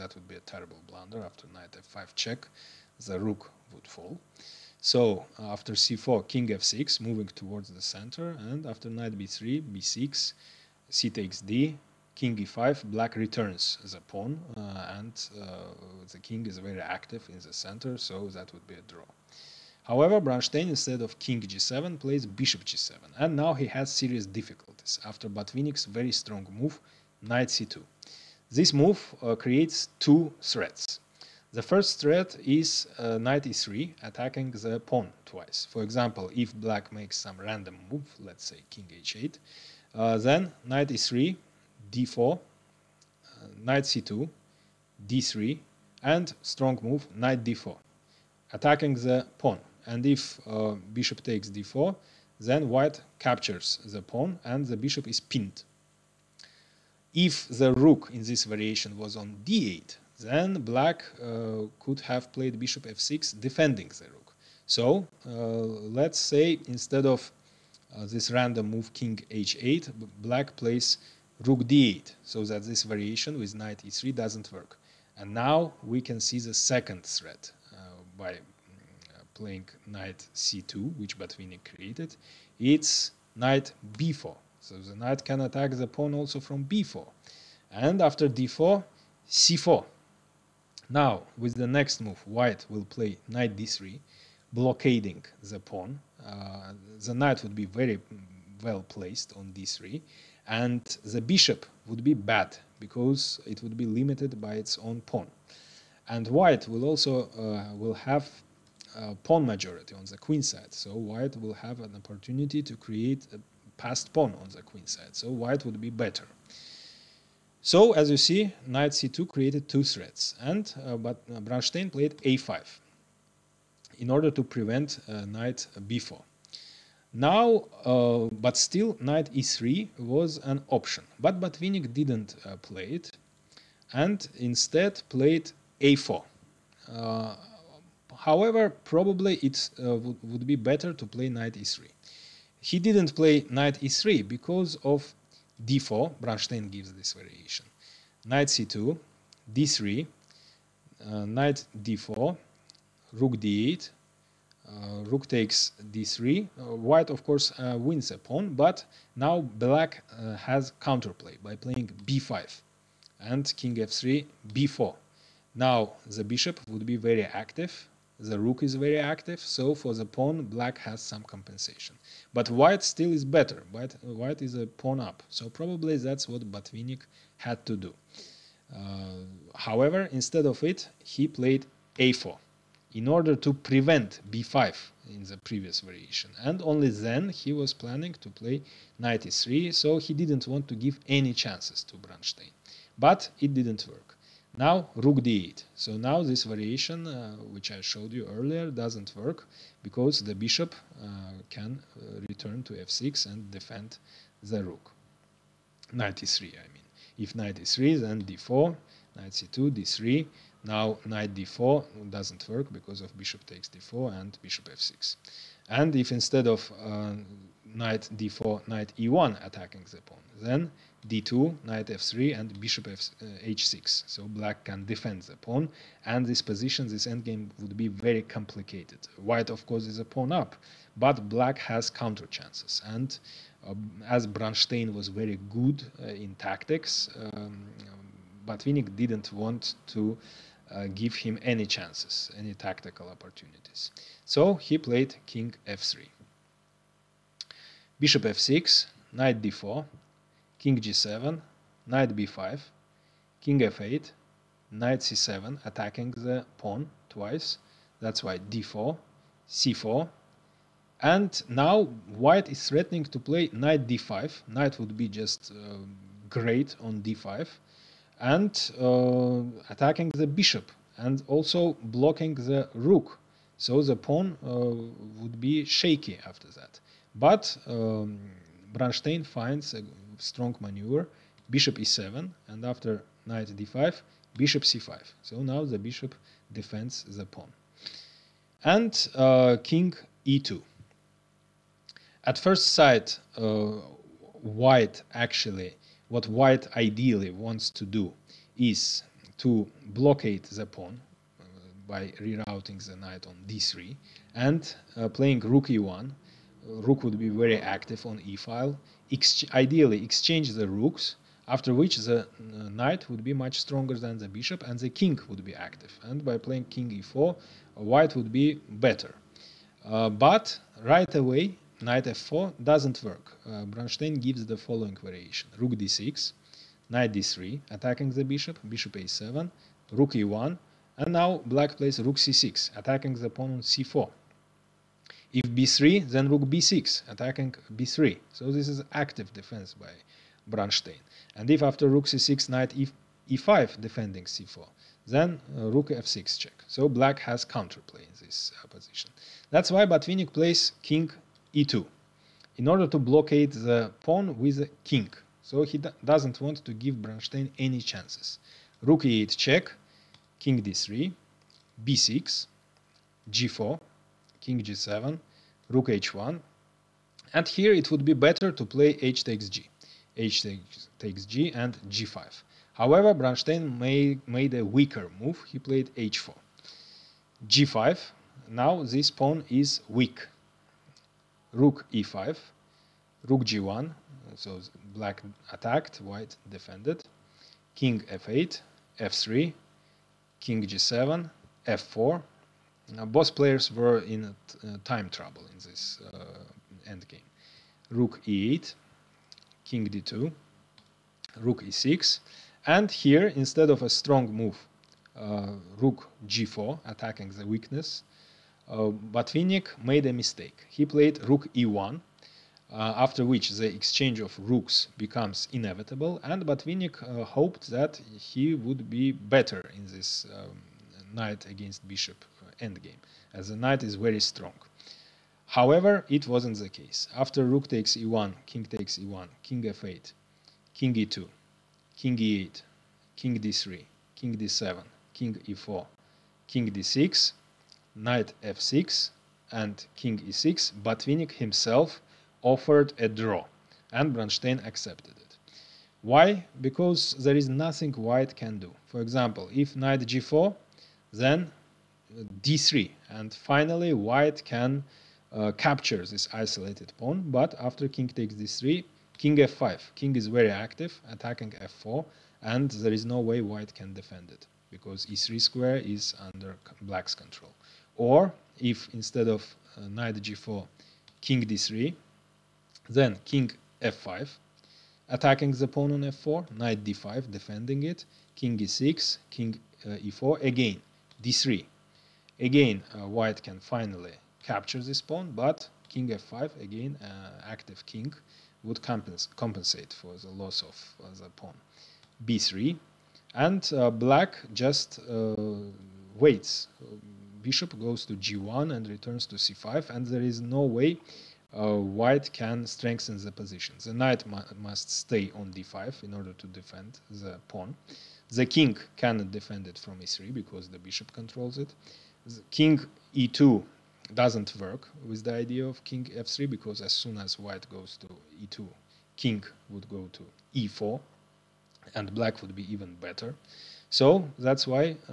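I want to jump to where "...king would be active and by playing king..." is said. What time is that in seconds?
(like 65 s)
314 s.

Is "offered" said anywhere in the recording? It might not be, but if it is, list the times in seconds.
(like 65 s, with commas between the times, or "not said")
442 s.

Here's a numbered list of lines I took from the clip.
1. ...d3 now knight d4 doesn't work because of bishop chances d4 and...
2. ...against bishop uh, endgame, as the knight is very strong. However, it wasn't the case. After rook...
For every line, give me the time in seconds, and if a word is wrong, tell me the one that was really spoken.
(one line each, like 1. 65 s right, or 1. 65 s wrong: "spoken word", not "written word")
1. 209 s wrong: "takes", not "chances"
2. 421 s right.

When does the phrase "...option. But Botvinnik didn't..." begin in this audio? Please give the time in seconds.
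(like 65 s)
130 s.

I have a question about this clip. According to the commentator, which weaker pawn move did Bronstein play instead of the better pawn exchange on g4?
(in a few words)
h4.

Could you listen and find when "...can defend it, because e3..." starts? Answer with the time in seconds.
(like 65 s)
463 s.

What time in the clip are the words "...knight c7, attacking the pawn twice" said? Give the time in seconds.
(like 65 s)
254 s.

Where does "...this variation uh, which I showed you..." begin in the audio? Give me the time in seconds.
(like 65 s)
196 s.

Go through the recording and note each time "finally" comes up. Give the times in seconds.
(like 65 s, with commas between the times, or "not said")
453 s, 483 s.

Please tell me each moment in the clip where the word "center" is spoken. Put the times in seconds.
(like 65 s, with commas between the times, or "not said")
7 s, 17 s.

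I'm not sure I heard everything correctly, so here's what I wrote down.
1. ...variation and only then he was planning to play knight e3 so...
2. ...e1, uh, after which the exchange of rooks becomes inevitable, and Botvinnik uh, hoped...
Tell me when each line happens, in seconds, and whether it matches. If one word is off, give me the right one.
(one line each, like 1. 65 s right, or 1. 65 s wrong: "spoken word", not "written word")
1. 185 s right
2. 411 s right.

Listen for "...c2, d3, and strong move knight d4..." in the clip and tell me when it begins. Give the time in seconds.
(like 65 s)
43 s.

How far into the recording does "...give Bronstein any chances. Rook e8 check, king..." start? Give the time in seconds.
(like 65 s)
356 s.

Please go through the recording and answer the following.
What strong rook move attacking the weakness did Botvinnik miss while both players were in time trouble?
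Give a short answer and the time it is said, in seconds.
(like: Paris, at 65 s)
Rook g4, at 405 s.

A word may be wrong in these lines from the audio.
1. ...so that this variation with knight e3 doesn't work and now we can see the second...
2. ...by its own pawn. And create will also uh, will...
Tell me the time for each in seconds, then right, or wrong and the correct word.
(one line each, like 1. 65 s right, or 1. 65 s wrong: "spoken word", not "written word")
1. 72 s right
2. 104 s wrong: "white", not "create".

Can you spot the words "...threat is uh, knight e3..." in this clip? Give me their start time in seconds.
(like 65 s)
31 s.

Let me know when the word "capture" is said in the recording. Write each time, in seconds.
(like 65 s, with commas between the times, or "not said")
53 s, 455 s, 484 s.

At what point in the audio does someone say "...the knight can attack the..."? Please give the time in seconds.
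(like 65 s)
84 s.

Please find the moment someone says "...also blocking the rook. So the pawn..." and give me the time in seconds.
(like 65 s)
271 s.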